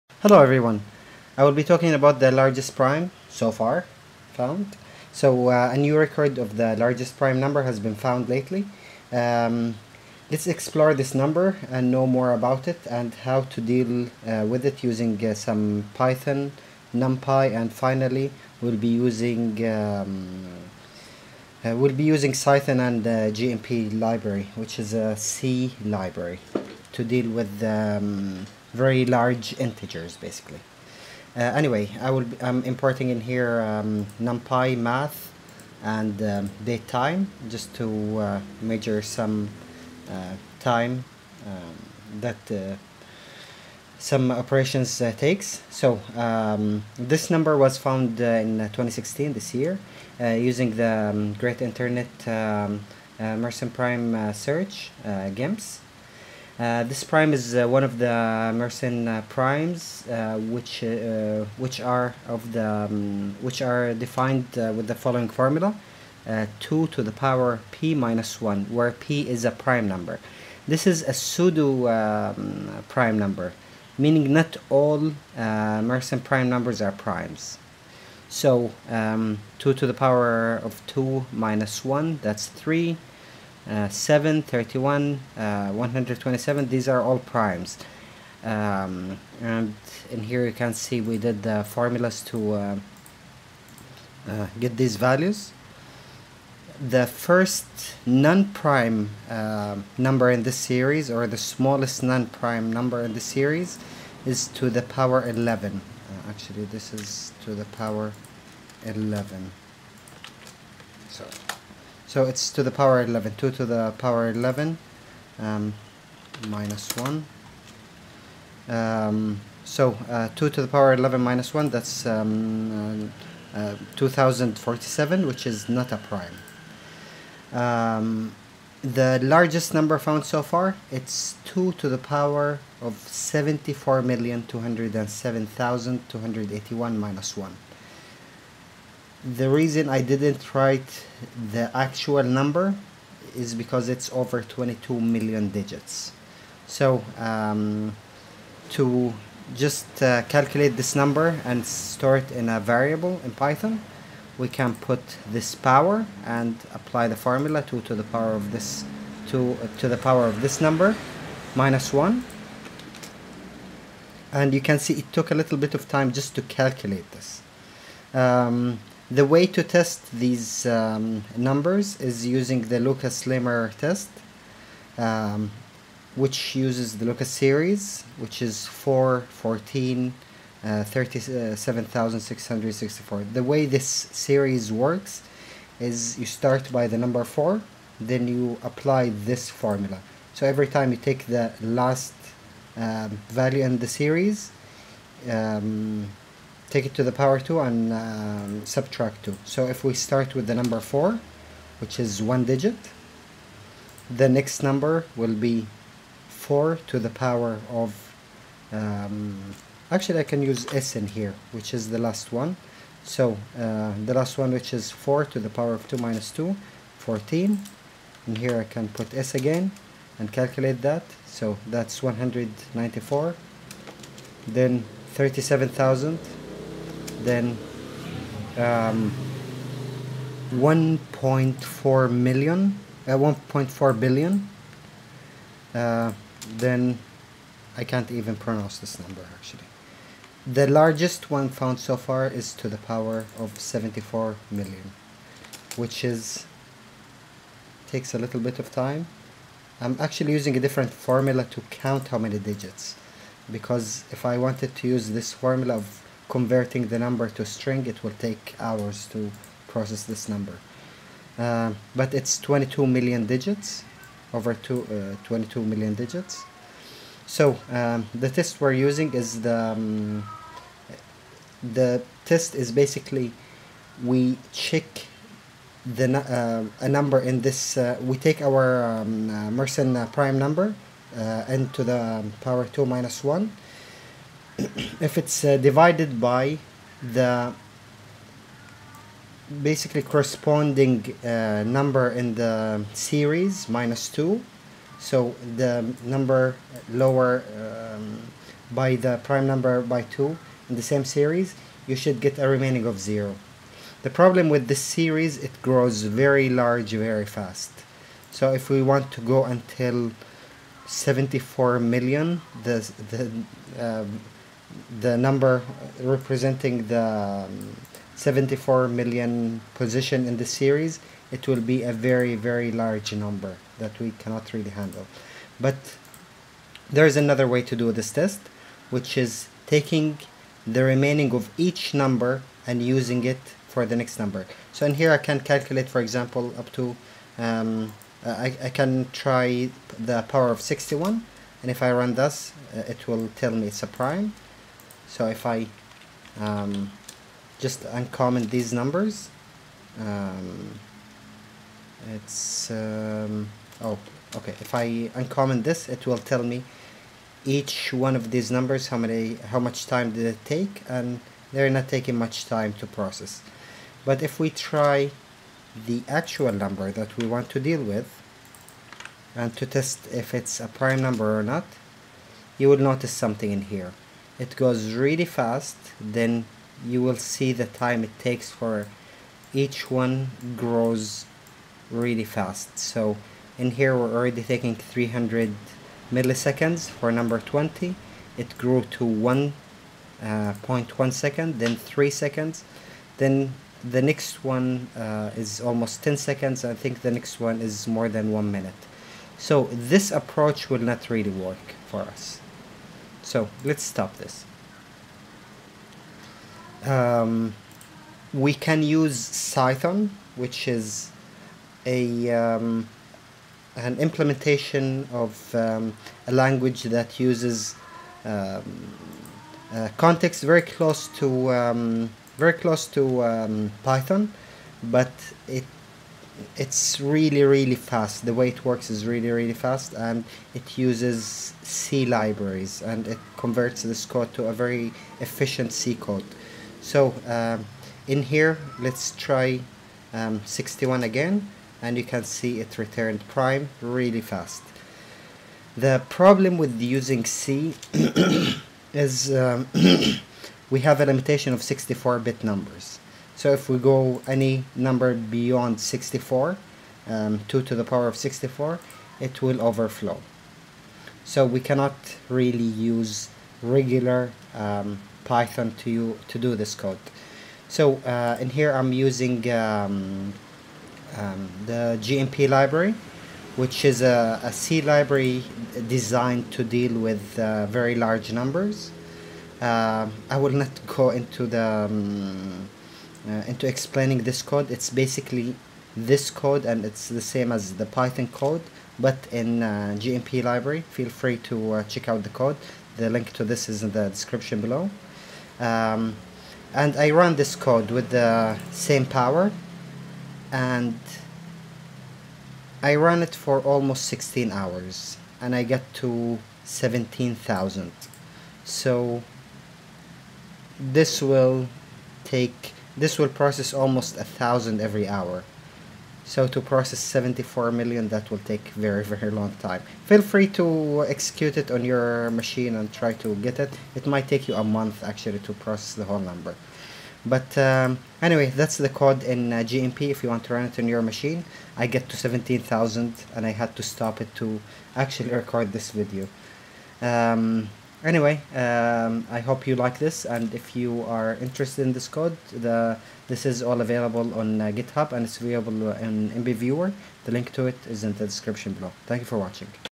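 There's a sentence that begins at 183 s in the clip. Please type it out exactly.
Uh, the way this series works is you start by the number 4, then you apply this formula.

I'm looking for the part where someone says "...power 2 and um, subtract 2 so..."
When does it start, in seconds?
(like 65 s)
197 s.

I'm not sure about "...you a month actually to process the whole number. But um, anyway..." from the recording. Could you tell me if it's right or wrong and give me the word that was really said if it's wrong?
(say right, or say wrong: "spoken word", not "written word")
right.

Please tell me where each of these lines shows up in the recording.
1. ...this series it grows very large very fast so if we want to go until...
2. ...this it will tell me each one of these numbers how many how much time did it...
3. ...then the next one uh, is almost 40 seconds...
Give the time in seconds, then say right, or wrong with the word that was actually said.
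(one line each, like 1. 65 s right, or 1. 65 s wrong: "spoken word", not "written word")
1. 304 s right
2. 355 s right
3. 393 s wrong: "10", not "40".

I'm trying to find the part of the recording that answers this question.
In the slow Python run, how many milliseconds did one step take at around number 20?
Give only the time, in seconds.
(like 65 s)
384 s.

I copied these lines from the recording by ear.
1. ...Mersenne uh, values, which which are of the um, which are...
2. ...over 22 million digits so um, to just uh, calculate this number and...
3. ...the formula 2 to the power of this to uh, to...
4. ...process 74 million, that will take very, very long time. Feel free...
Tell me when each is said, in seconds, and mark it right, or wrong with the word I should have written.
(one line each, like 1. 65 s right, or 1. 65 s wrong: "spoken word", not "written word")
1. 58 s wrong: "primes", not "values"
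2. 144 s right
3. 157 s right
4. 516 s right.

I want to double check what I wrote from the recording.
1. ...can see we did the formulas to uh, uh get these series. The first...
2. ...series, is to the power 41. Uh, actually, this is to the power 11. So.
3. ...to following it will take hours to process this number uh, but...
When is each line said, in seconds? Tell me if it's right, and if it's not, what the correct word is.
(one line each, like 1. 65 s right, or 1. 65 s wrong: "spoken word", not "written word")
1. 90 s wrong: "values", not "series"
2. 103 s wrong: "11", not "41"
3. 257 s wrong: "string", not "following".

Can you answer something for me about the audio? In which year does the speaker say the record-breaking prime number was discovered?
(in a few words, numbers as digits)
2016.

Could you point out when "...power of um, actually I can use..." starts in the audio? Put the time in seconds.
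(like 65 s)
207 s.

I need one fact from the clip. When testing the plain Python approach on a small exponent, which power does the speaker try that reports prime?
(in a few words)
61.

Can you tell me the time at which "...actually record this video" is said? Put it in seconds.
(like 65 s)
534 s.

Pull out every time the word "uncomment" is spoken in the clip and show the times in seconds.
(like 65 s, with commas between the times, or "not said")
347 s, 355 s.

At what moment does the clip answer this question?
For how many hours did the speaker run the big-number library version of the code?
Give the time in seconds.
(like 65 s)
504 s.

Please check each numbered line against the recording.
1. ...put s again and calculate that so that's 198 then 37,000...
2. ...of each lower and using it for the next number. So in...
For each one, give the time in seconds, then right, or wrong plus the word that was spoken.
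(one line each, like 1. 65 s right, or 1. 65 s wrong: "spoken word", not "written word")
1. 218 s wrong: "194", not "198"
2. 331 s wrong: "number", not "lower".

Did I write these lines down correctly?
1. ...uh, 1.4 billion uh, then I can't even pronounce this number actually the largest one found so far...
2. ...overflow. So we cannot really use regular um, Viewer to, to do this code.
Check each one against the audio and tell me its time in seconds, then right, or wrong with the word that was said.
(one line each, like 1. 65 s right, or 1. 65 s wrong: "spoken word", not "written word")
1. 233 s right
2. 459 s wrong: "Python", not "Viewer".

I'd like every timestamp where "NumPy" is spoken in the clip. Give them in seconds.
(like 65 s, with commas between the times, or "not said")
16 s, 34 s.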